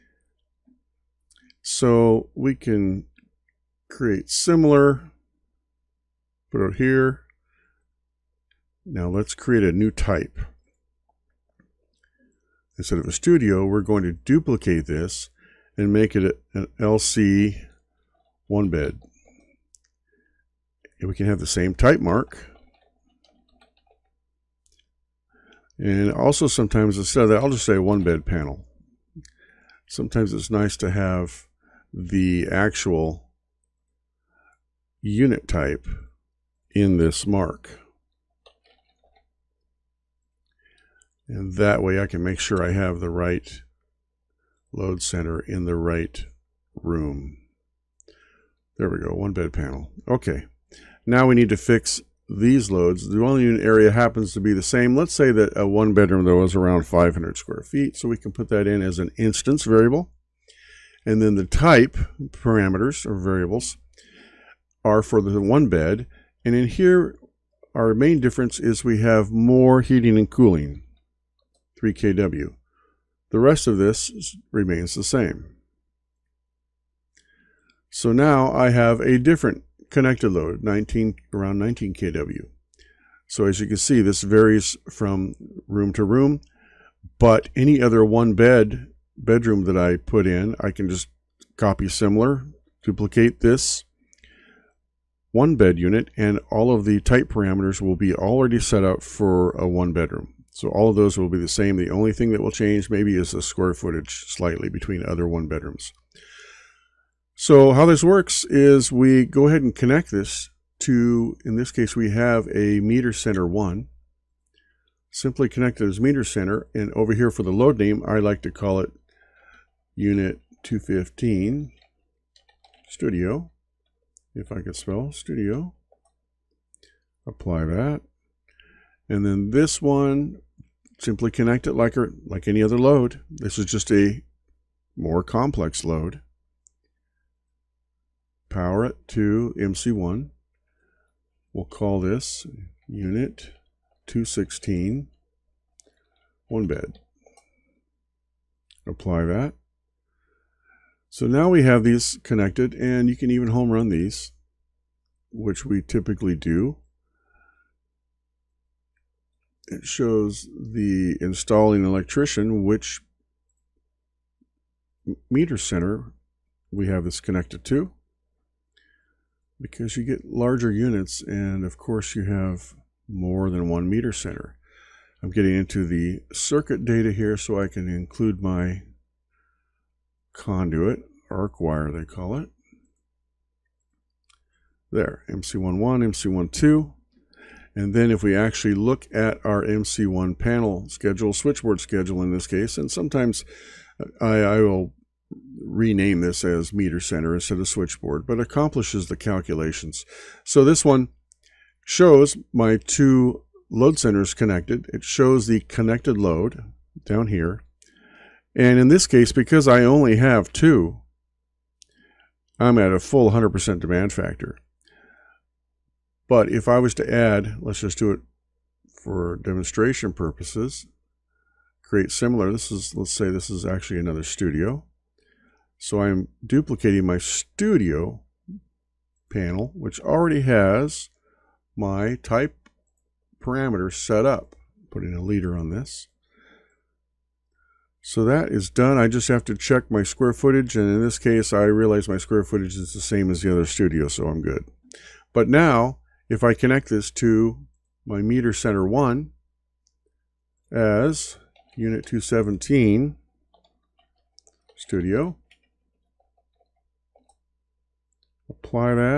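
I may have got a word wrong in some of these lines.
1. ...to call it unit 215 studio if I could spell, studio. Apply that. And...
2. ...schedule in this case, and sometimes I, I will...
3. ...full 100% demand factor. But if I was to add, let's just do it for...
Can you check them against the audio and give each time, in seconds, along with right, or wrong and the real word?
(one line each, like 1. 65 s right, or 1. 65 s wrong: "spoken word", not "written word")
1. 118 s right
2. 191 s right
3. 212 s right.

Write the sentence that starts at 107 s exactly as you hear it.
So how this works is we go ahead and connect this to, in this case, we have a meter center one.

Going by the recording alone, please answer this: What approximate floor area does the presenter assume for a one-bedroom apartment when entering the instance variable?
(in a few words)
500 square feet.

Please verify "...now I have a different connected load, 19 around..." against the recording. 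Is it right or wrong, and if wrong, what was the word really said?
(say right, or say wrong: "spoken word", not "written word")
right.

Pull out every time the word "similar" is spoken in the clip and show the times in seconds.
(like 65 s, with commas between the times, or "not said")
4 s, 91 s, 222 s.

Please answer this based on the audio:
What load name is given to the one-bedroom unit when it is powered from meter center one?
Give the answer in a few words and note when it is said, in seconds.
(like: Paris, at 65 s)
unit 216 one bed, at 142 s.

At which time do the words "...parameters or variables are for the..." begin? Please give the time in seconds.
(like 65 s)
62 s.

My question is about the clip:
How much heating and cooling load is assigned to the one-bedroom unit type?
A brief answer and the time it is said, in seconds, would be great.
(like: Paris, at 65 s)
3 kW, at 71 s.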